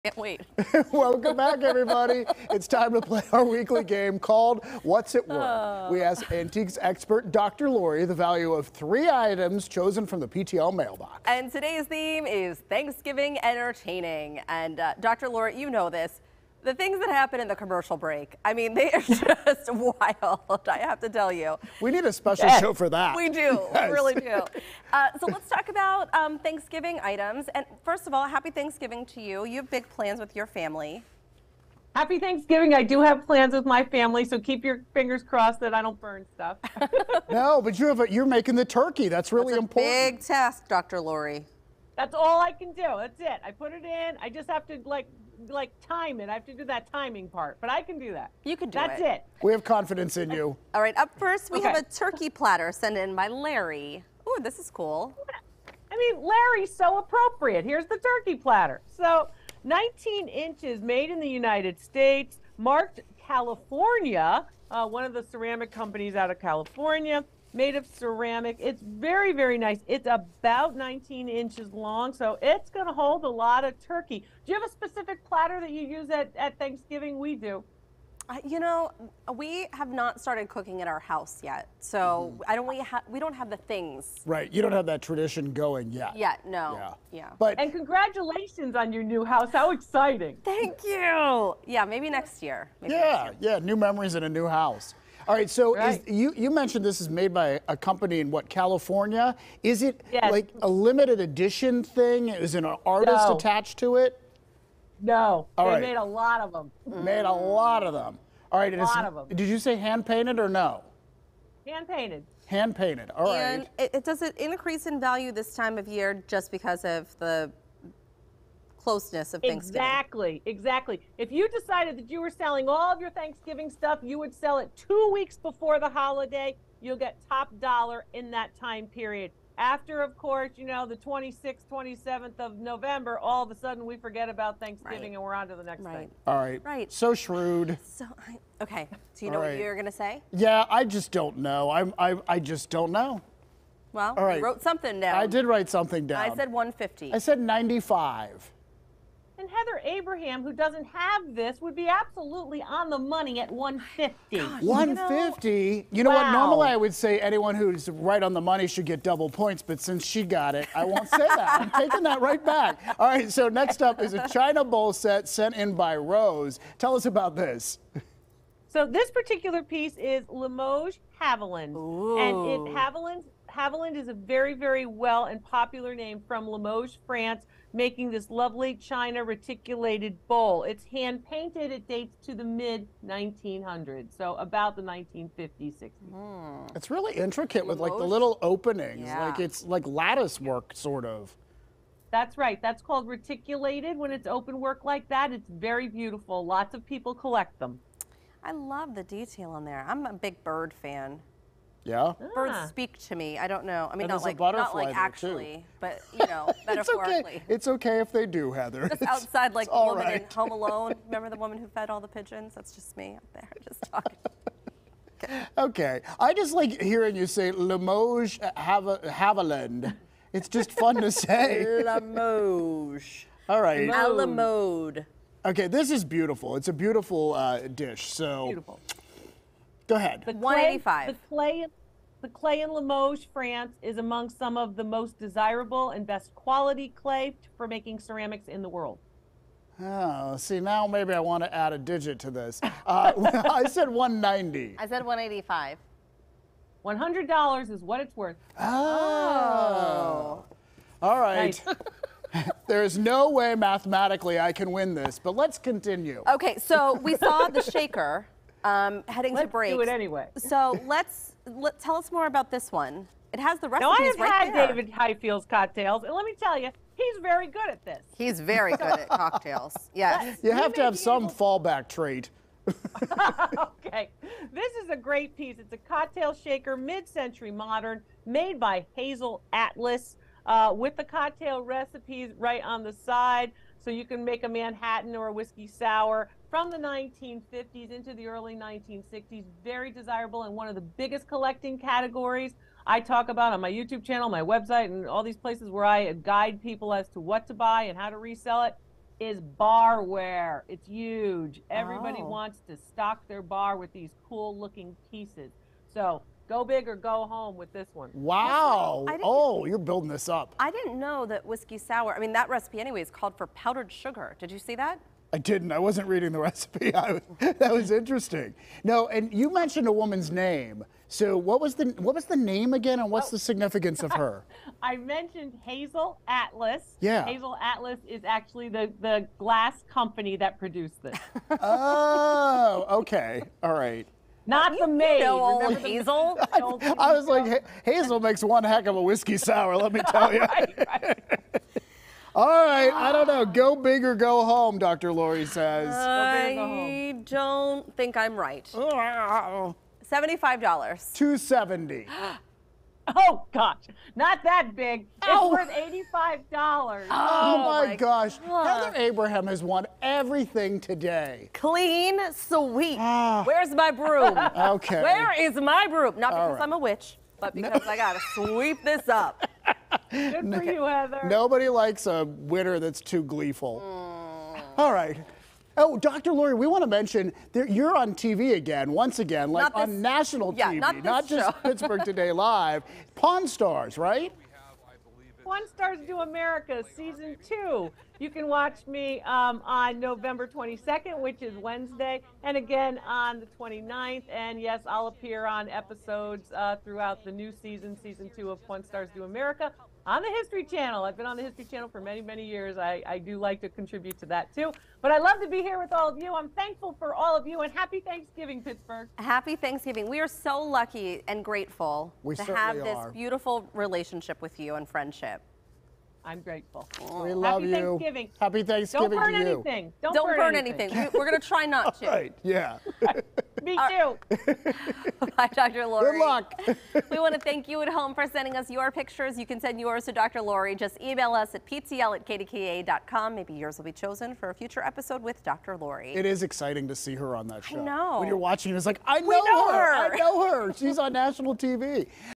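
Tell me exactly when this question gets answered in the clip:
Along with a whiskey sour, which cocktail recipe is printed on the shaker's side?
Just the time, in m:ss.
4:44.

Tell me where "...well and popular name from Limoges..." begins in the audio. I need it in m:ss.
2:54.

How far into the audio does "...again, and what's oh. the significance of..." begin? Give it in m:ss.
5:22.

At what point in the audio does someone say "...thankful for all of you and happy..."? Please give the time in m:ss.
6:46.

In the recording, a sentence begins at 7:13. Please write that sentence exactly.
Maybe yours will be chosen for a future episode with Dr.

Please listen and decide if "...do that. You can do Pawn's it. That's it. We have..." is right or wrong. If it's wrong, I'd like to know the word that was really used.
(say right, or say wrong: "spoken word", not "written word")
wrong: "That", not "Pawn".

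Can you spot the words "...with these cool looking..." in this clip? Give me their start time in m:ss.
5:03.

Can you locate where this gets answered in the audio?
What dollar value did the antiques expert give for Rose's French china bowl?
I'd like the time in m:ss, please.
4:06.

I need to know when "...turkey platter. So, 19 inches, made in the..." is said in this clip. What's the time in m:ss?
0:57.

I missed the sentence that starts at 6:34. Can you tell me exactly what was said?
And yes, I'll appear on episodes uh, throughout the new season, season two of Pawn Stars Do America on the History Channel.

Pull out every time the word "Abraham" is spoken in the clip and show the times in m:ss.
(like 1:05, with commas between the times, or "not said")
2:29, 5:58.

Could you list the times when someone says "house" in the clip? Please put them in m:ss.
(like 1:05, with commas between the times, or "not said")
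1:21, 1:29, 1:34.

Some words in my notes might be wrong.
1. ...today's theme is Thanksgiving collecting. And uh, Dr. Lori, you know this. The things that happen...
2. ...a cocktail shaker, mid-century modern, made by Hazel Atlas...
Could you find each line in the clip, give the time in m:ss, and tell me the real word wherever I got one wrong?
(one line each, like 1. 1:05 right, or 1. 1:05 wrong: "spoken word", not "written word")
1. 0:11 wrong: "entertaining", not "collecting"
2. 4:35 right.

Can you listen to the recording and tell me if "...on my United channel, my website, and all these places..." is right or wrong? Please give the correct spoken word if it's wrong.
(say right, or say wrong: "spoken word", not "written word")
wrong: "YouTube", not "United".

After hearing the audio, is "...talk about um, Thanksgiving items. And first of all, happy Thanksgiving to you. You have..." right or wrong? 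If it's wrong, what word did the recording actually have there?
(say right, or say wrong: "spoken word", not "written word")
right.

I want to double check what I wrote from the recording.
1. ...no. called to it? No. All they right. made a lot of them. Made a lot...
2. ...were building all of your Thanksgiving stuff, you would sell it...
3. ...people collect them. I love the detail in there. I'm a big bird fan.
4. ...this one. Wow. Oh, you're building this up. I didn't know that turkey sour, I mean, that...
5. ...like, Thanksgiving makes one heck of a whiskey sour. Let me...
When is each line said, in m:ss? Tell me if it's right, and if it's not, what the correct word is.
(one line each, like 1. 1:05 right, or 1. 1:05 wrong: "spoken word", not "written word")
1. 1:43 wrong: "attached", not "called"
2. 2:02 wrong: "selling", not "building"
3. 3:16 right
4. 5:07 wrong: "whiskey", not "turkey"
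5. 5:37 wrong: "Hazel", not "Thanksgiving".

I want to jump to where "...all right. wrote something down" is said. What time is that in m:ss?
2:24.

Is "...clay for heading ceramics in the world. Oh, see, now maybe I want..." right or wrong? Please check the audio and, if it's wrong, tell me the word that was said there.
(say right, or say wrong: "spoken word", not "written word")
wrong: "making", not "heading".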